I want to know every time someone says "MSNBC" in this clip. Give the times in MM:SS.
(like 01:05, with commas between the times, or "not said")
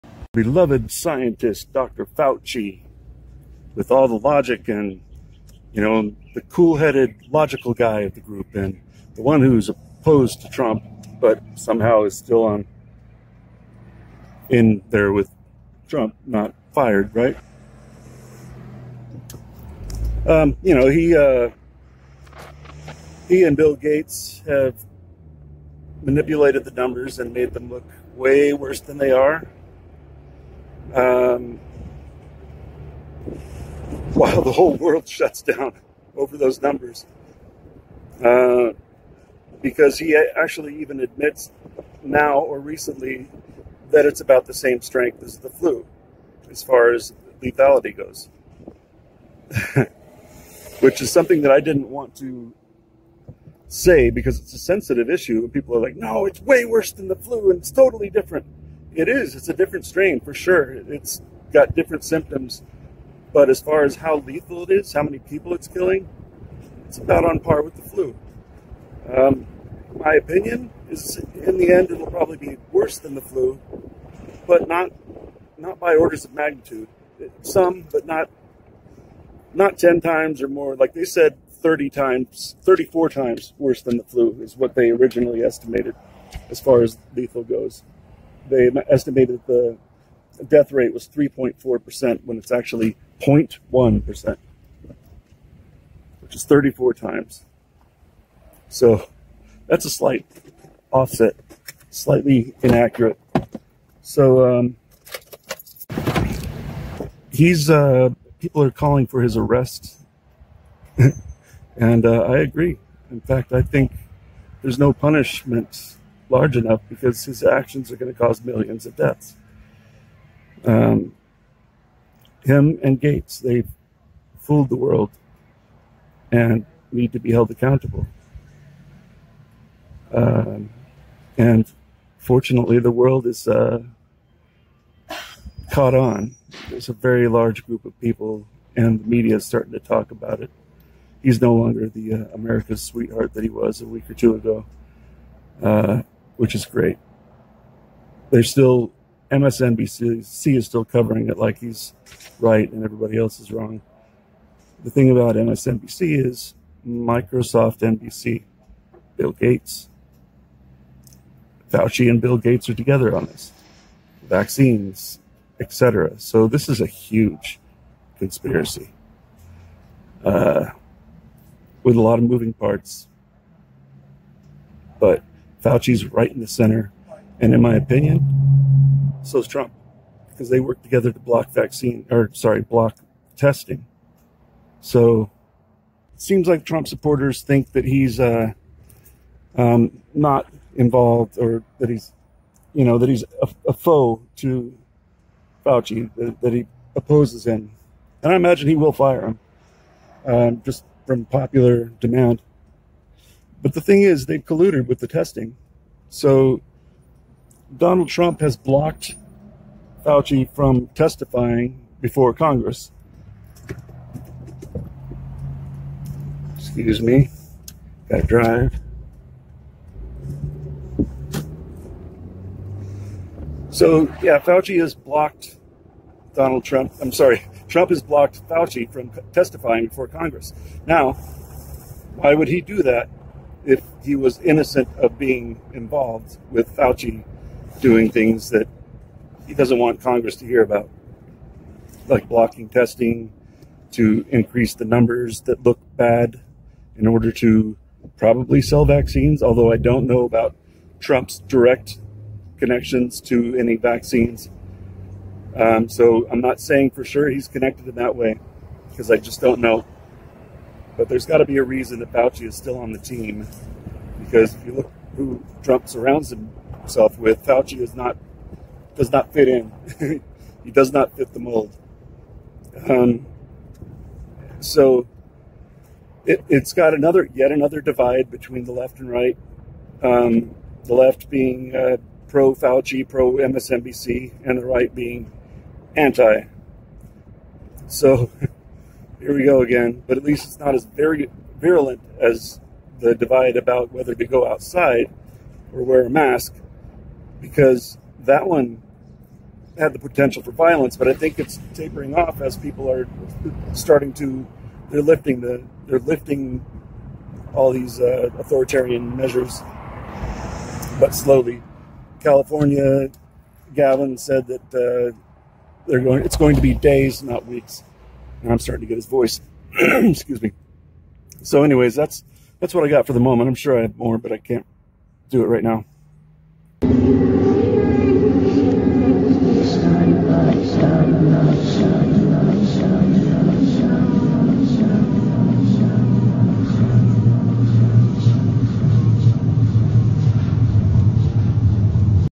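02:29, 02:35, 04:43.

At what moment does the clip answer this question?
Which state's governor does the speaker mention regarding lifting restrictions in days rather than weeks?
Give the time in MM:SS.
05:12.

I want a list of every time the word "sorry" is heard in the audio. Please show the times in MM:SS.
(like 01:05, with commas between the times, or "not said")
03:02, 03:47.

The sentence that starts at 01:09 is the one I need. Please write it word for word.
Um, my opinion is in the end it'll probably be worse than the flu, but not not by orders of magnitude.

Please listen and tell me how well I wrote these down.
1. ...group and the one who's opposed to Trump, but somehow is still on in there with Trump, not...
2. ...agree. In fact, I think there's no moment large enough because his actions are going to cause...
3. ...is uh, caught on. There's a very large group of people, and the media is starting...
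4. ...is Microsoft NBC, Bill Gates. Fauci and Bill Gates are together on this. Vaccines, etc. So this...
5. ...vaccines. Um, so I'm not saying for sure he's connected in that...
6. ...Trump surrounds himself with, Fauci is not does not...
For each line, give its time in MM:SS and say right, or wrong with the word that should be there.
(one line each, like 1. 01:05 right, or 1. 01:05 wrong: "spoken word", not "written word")
1. 00:08 right
2. 01:52 wrong: "punishment", not "moment"
3. 02:13 right
4. 02:36 right
5. 04:13 right
6. 04:25 right.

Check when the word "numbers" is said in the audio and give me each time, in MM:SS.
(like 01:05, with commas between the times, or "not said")
00:26, 00:36, 04:04.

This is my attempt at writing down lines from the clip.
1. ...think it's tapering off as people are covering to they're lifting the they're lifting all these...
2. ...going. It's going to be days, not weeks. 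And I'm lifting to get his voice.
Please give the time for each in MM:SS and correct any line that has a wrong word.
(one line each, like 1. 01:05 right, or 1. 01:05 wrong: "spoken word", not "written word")
1. 05:01 wrong: "starting", not "covering"
2. 05:16 wrong: "starting", not "lifting".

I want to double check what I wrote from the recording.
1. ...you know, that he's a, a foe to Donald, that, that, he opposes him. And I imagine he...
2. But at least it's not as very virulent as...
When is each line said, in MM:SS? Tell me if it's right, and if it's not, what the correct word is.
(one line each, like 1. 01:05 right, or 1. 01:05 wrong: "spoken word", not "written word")
1. 03:12 wrong: "Fauci", not "Donald"
2. 04:50 right.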